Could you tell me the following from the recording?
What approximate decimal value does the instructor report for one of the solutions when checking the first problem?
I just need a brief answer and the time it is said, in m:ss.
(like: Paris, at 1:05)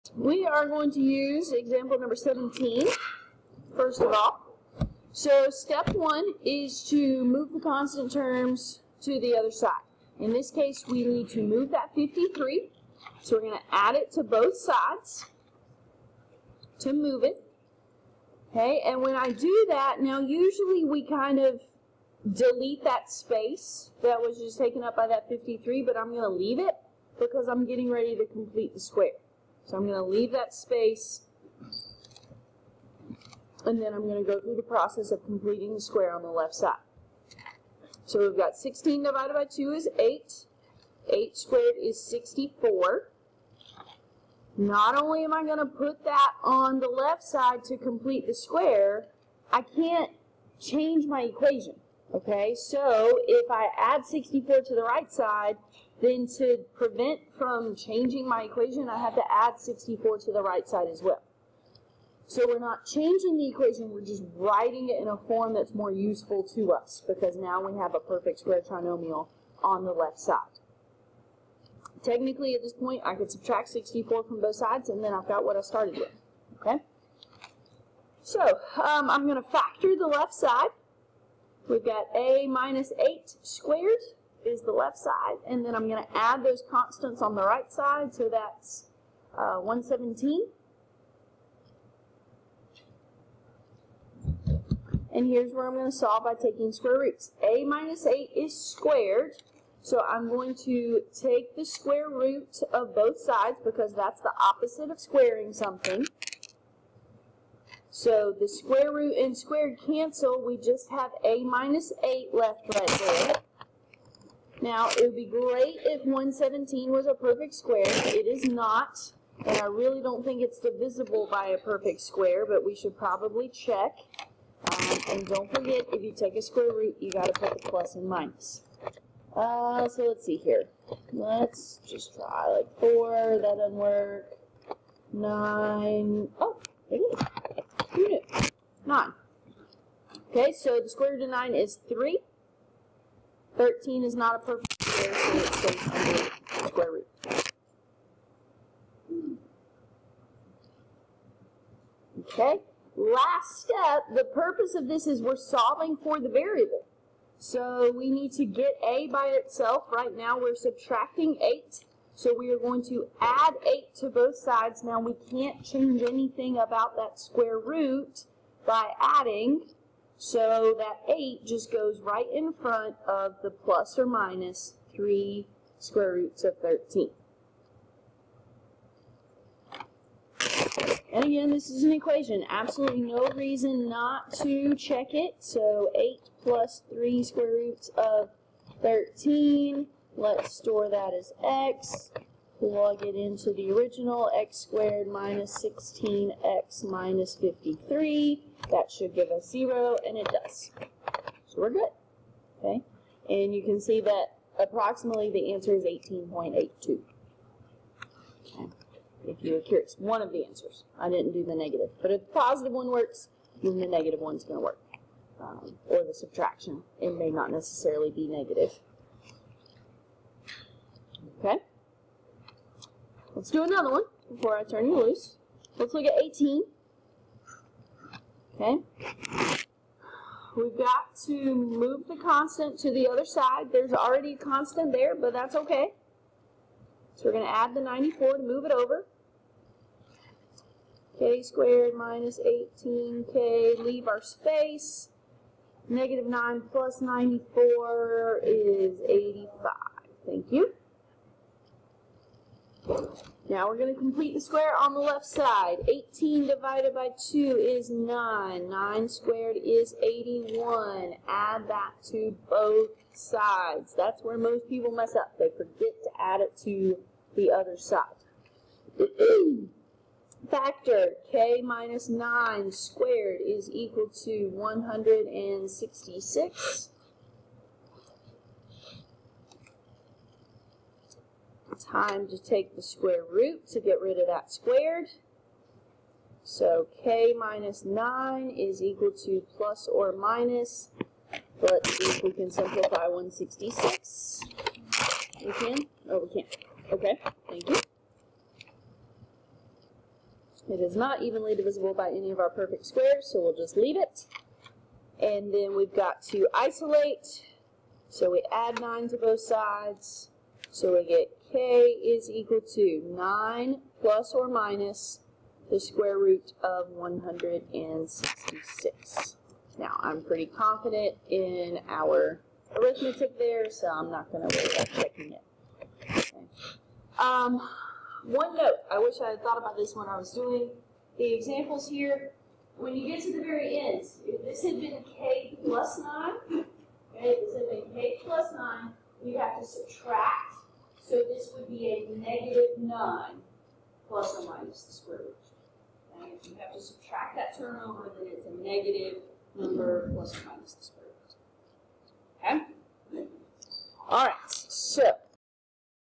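18.82, at 3:25.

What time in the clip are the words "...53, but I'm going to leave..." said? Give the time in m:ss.
0:25.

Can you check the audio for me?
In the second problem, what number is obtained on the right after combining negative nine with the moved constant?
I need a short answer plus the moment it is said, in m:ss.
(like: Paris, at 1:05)
85, at 4:09.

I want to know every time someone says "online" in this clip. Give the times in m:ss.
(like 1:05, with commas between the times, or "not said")
not said.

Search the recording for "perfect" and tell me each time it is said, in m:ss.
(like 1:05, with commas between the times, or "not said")
1:07, 1:57, 2:01, 2:24, 5:02.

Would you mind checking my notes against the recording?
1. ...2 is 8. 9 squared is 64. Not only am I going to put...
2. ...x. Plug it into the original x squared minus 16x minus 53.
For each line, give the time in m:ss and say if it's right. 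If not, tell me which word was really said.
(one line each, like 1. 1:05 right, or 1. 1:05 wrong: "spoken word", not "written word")
1. 0:39 wrong: "8", not "9"
2. 3:11 right.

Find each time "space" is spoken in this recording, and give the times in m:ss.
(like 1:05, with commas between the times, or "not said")
0:23, 0:30, 4:04.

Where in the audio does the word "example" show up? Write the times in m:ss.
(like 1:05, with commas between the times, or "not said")
0:01, 5:31.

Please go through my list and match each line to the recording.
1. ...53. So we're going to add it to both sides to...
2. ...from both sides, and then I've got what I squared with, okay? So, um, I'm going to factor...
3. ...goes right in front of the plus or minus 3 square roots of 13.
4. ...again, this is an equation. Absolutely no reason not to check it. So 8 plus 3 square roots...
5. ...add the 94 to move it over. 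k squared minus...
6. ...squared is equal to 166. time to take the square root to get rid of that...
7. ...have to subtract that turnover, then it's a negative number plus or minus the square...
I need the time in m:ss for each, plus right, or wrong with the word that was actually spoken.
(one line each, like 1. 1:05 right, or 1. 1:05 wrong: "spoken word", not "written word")
1. 0:11 right
2. 1:14 wrong: "started", not "squared"
3. 2:51 right
4. 3:01 right
5. 3:57 right
6. 4:32 right
7. 5:46 right.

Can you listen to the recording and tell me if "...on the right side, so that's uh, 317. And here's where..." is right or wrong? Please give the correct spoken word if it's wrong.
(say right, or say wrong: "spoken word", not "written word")
wrong: "117", not "317".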